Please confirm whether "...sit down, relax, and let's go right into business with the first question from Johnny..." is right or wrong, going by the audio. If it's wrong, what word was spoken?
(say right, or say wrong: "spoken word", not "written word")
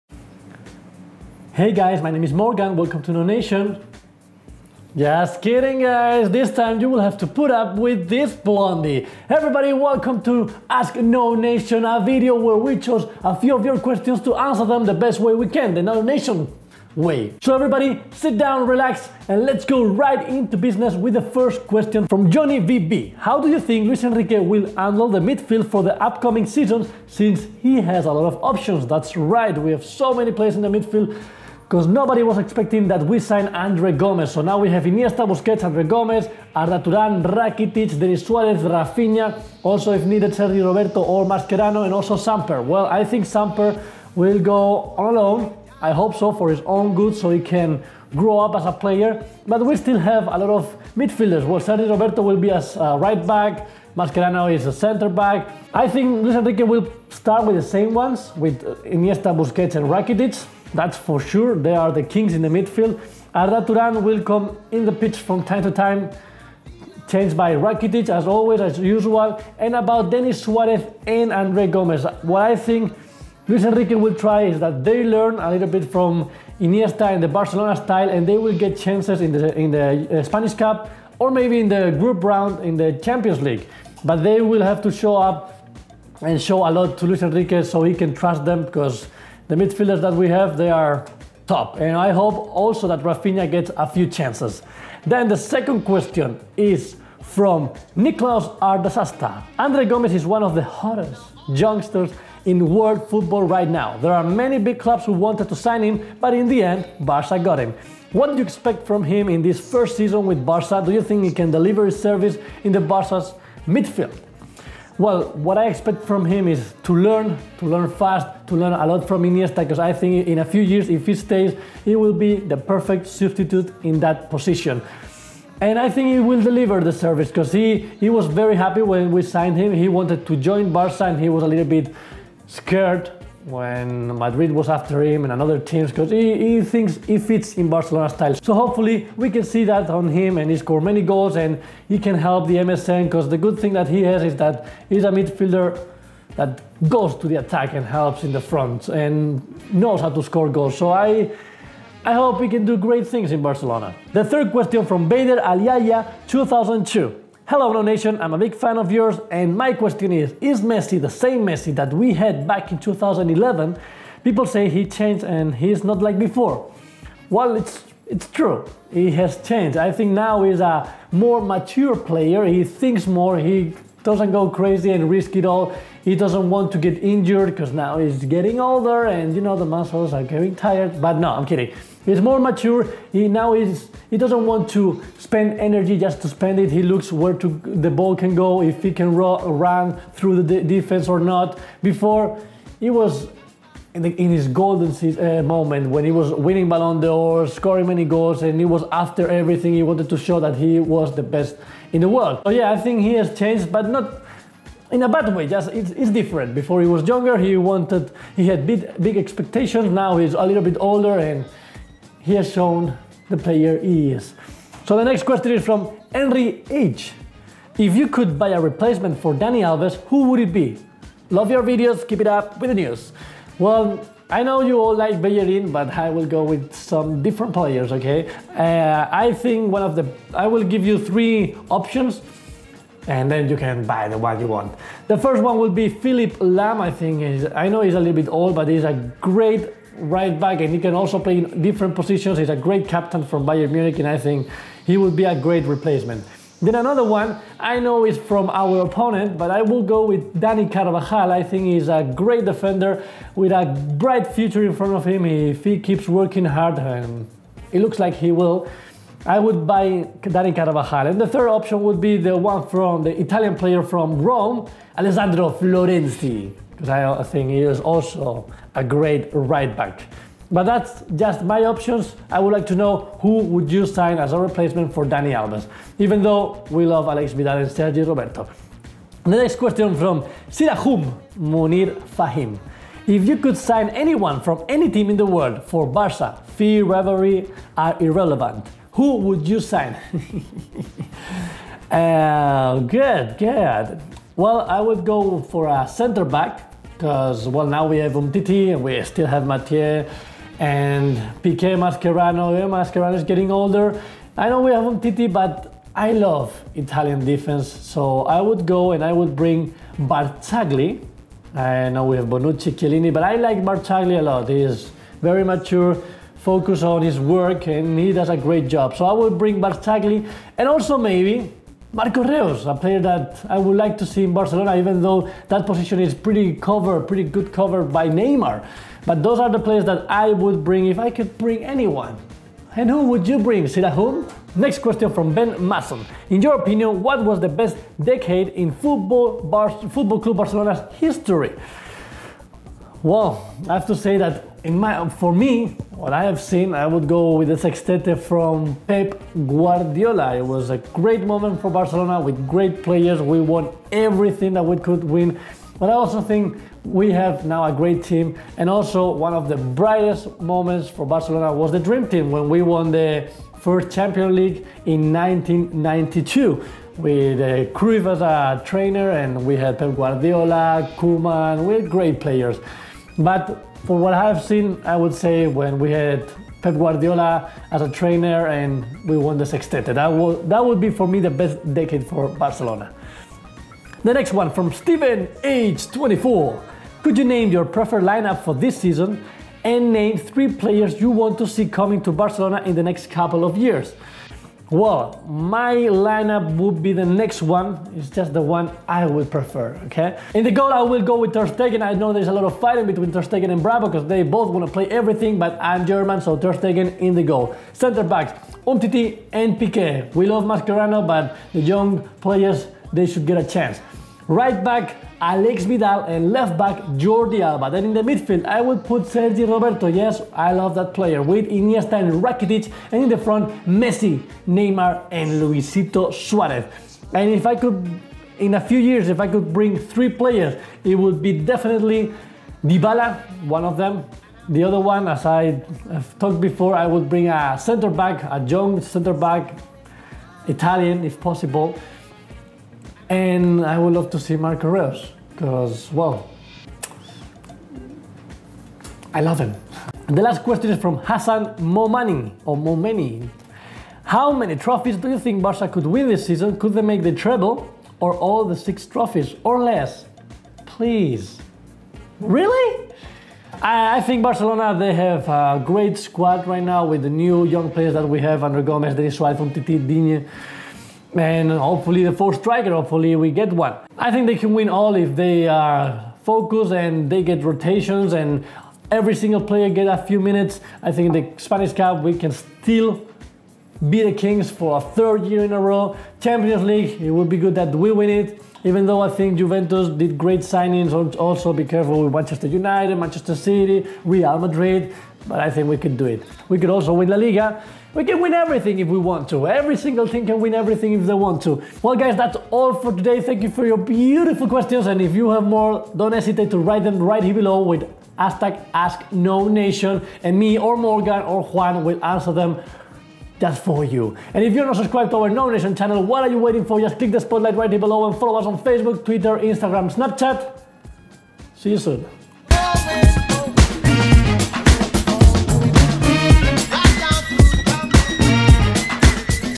right.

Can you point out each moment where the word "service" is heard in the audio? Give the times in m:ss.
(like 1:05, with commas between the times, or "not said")
1:52, 2:06.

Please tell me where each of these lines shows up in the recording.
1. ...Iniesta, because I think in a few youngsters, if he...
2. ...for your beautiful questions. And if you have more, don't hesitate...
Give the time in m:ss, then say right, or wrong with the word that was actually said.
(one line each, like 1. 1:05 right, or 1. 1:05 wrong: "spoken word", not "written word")
1. 1:59 wrong: "years", not "youngsters"
2. 8:23 right.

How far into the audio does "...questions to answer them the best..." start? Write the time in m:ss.
0:13.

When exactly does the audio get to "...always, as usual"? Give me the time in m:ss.
1:08.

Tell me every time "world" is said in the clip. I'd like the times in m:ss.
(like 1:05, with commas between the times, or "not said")
1:42, 3:22, 4:45.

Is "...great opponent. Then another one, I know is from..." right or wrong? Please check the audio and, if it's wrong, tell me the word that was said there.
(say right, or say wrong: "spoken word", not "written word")
wrong: "replacement", not "opponent".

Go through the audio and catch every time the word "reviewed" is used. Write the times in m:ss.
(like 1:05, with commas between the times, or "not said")
not said.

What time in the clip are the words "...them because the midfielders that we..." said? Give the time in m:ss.
1:28.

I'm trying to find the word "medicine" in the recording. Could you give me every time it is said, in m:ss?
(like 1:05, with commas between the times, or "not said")
not said.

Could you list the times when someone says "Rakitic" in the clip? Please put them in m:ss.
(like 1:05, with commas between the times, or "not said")
0:37, 0:59, 1:07, 7:02.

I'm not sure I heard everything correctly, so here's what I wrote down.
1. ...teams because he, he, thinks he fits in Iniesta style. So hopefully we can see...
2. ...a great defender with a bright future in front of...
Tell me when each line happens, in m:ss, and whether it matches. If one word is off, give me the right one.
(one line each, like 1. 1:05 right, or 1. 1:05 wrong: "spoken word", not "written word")
1. 2:15 wrong: "Barcelona", not "Iniesta"
2. 4:11 right.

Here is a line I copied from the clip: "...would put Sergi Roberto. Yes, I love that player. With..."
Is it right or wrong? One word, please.
right.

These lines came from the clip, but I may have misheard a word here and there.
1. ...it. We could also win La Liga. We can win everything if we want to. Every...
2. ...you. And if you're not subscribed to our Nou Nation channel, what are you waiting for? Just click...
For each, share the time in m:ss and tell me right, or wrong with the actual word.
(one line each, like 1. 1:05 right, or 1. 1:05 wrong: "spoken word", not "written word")
1. 8:16 right
2. 8:33 right.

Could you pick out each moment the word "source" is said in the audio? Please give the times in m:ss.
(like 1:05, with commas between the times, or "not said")
not said.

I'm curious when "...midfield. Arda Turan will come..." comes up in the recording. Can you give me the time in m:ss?
1:02.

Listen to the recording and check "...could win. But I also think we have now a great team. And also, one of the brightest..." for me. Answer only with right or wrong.
right.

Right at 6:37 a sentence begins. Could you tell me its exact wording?
It's just the one I would prefer, okay?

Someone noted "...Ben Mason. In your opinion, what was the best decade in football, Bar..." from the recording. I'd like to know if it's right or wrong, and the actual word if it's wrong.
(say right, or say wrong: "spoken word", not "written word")
right.